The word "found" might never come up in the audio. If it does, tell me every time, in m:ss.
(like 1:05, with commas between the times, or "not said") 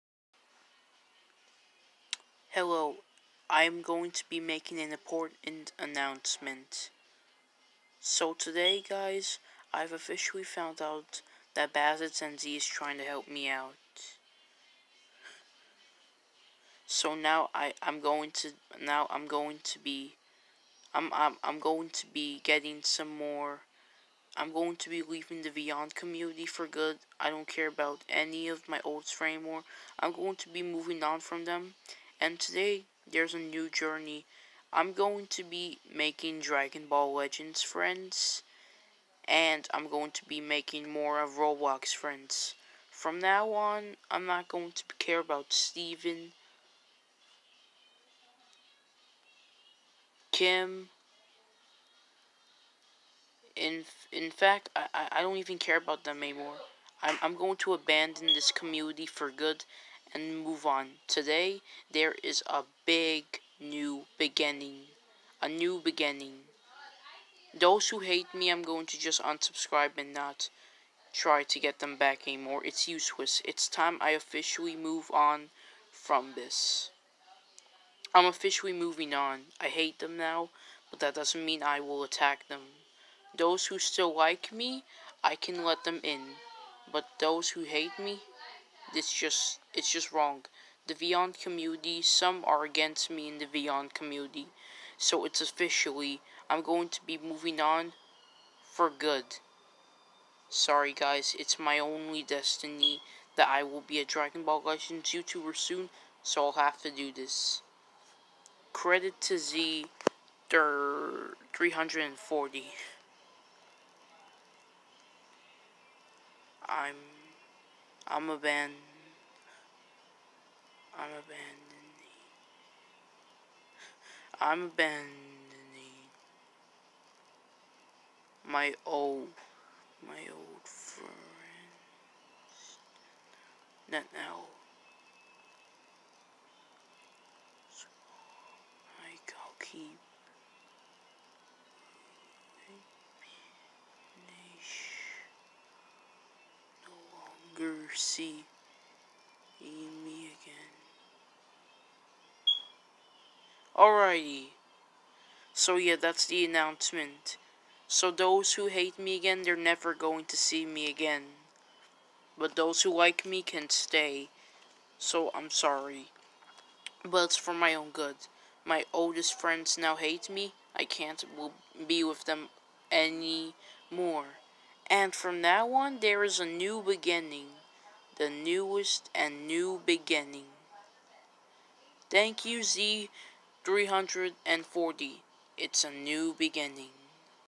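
0:10.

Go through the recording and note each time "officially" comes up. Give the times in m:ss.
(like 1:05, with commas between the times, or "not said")
0:09, 1:14, 1:18, 1:35.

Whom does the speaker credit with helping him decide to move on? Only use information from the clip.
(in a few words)
Z 340.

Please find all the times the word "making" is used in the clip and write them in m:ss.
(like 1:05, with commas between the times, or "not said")
0:04, 0:35, 0:40.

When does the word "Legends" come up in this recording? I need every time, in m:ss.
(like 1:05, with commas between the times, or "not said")
0:37, 1:44.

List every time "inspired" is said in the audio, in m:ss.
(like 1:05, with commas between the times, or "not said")
not said.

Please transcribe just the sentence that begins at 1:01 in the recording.
Today, there is a big new beginning.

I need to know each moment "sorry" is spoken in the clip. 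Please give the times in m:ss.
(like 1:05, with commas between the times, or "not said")
1:40, 2:45.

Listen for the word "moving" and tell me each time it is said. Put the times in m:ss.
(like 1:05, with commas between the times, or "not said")
0:30, 1:18, 1:37.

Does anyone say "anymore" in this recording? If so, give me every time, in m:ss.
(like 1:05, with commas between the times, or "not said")
0:29, 0:56, 1:12, 2:52.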